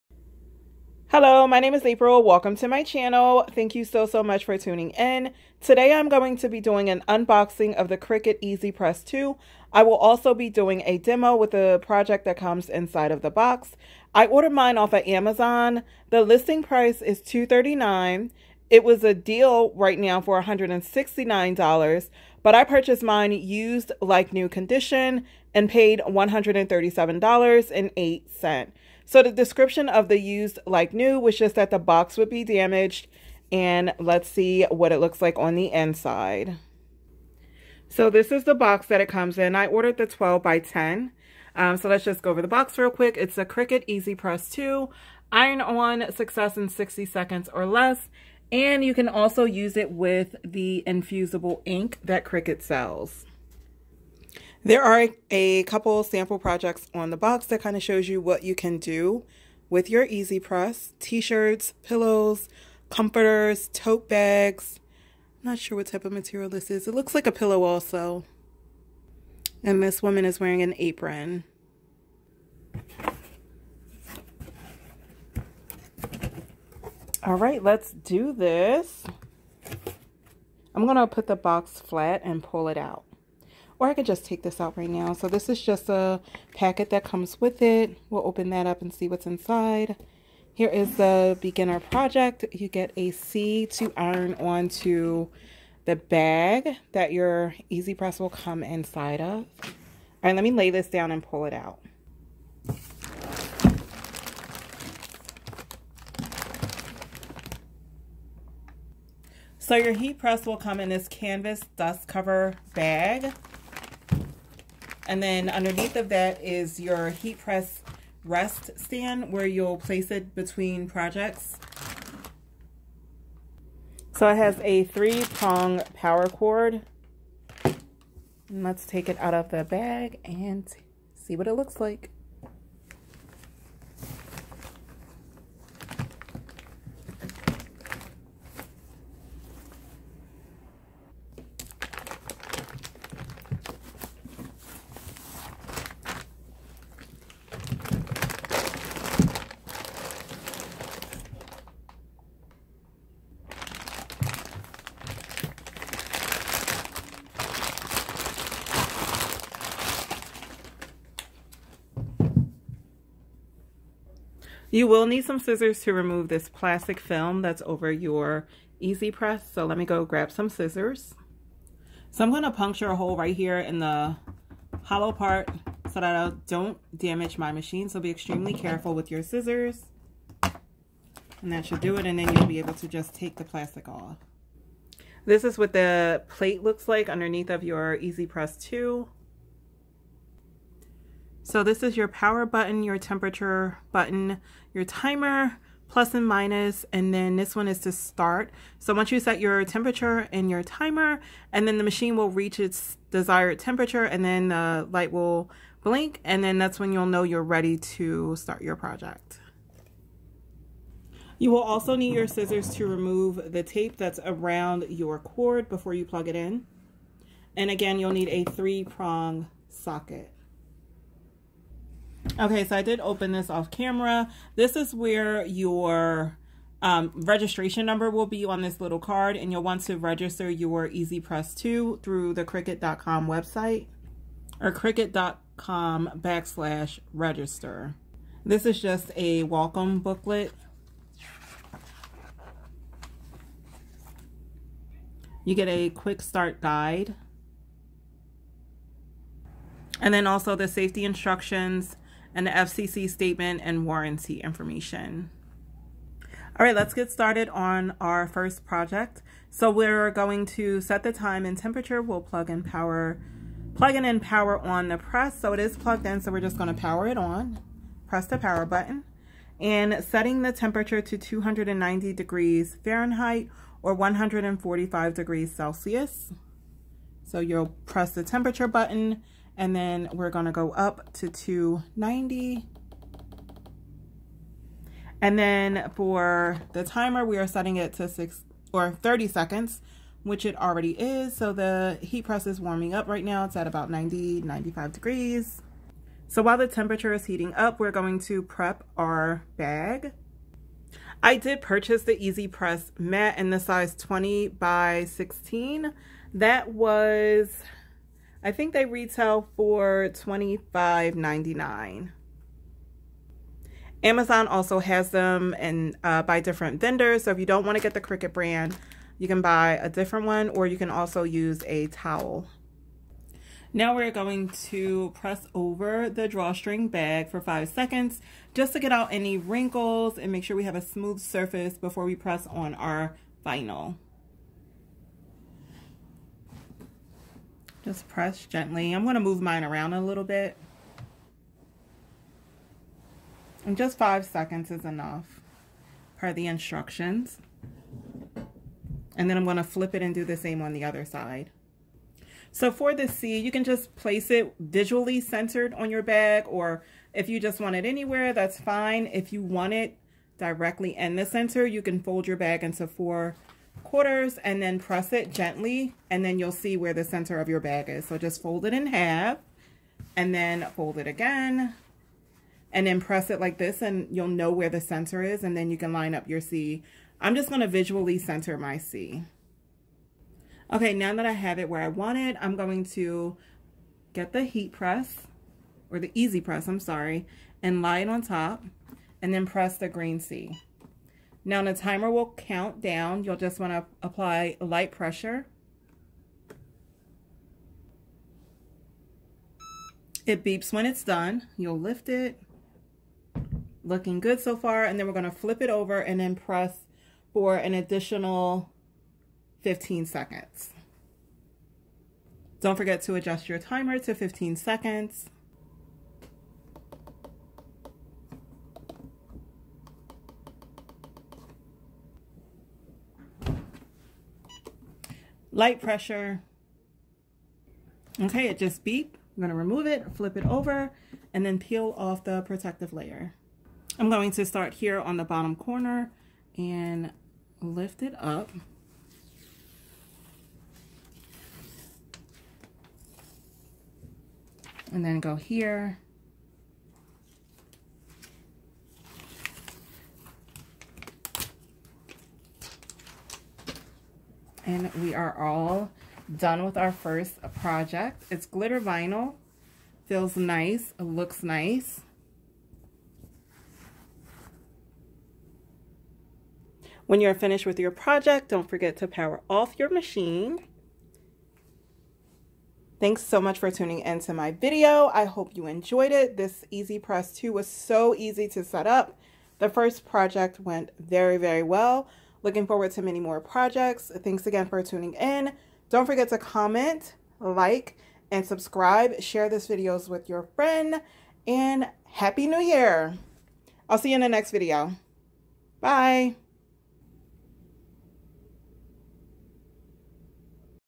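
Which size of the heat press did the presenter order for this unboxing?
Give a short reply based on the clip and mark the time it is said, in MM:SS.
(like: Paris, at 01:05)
12 by 10, at 00:40.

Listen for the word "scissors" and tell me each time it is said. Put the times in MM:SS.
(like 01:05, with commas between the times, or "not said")
02:45, 02:50, 02:59, 03:32.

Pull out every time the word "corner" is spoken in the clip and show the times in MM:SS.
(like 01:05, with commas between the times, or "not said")
07:15.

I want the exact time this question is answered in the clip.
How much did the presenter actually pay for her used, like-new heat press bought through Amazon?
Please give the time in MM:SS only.
00:26.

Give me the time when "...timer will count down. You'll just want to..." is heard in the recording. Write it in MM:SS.
06:31.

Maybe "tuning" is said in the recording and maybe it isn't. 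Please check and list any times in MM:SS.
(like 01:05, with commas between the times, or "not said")
00:04, 07:53, 08:04.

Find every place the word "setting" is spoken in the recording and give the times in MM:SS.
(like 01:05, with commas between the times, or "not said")
04:30, 04:47.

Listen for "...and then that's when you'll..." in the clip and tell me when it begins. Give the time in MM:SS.
03:26.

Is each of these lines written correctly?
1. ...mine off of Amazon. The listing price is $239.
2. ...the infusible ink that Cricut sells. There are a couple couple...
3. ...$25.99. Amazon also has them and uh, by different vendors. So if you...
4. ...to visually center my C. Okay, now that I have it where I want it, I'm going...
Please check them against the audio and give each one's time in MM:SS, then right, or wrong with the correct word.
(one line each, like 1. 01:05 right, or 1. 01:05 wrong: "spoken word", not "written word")
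1. 00:14 right
2. 00:50 wrong: "sample", not "couple"
3. 05:10 right
4. 06:17 right.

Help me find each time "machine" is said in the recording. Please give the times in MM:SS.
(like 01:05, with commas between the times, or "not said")
02:57, 03:21, 07:49.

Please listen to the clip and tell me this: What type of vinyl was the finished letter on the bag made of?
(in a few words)
glitter vinyl.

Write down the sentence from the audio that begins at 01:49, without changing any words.
So your heat press will come in this canvas dust cover bag.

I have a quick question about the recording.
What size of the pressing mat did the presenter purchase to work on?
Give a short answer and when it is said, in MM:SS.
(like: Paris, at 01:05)
20 by 16, at 05:03.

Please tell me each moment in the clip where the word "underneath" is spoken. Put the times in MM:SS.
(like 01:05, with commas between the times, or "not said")
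01:55, 03:07.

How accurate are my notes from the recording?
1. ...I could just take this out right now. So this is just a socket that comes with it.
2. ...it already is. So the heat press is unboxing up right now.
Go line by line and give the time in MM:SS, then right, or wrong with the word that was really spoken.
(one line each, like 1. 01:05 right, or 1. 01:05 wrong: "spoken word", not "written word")
1. 01:23 wrong: "packet", not "socket"
2. 04:50 wrong: "warming", not "unboxing".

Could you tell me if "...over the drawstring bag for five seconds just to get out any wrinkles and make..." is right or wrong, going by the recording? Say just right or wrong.
right.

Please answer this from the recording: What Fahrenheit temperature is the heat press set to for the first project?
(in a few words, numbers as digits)
290.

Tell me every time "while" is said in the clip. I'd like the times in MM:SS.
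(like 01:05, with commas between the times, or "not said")
04:56.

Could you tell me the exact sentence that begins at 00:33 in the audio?
And let's see what it looks like on the inside.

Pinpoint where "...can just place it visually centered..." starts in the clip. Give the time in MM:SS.
05:53.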